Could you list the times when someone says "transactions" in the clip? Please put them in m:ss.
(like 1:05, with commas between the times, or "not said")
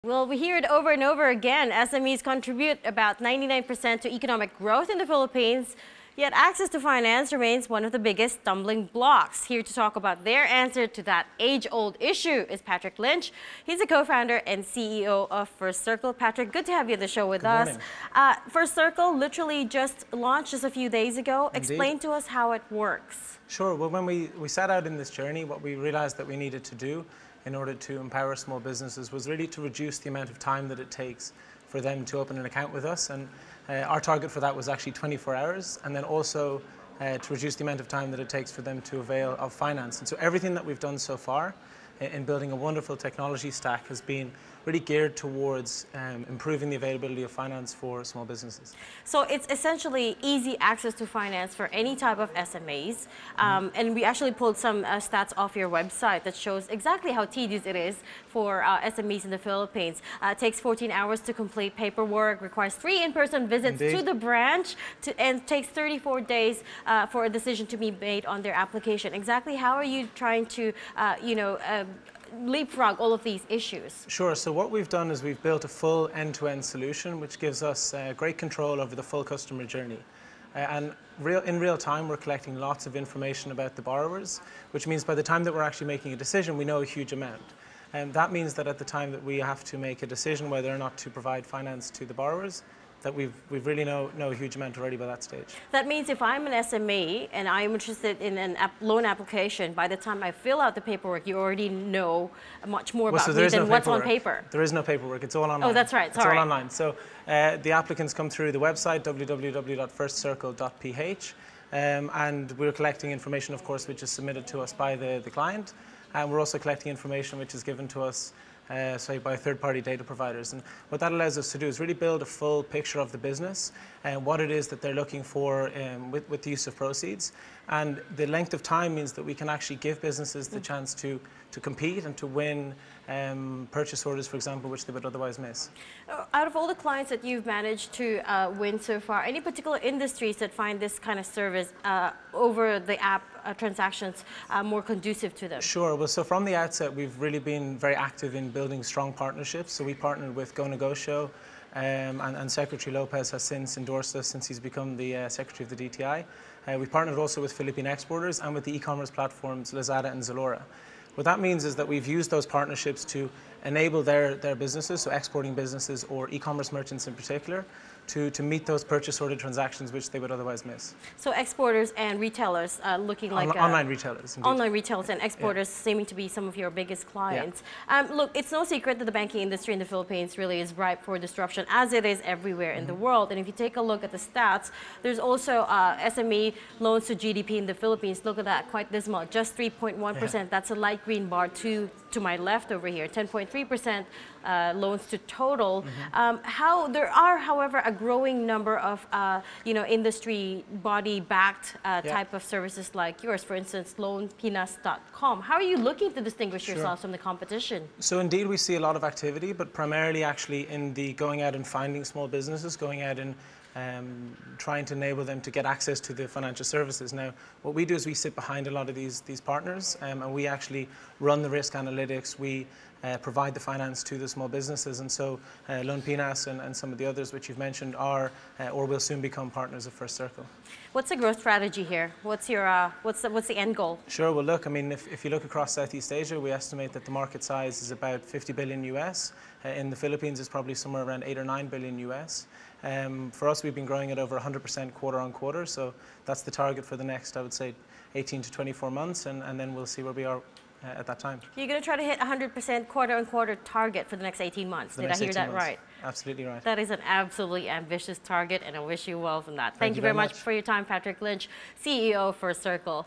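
2:23, 2:49.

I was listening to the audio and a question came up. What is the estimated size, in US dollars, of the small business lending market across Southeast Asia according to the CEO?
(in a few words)
50 billion US.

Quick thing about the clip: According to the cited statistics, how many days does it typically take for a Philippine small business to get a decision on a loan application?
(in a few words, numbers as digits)
34 days.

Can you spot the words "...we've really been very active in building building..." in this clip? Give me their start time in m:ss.
2:26.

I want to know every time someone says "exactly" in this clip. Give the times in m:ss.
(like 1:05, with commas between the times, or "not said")
0:56, 1:09.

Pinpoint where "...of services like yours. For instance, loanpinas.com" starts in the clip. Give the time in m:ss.
3:22.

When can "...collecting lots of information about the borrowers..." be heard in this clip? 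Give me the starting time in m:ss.
1:22.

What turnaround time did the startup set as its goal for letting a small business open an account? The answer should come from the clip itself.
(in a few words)
24 hours.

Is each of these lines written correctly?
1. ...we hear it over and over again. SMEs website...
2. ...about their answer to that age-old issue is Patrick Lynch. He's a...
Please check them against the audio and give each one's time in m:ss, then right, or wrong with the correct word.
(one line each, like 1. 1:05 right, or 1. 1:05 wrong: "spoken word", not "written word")
1. 0:00 wrong: "contribute", not "website"
2. 0:09 right.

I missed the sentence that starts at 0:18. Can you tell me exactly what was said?
Uh, First Circle literally just launched just a few days ago.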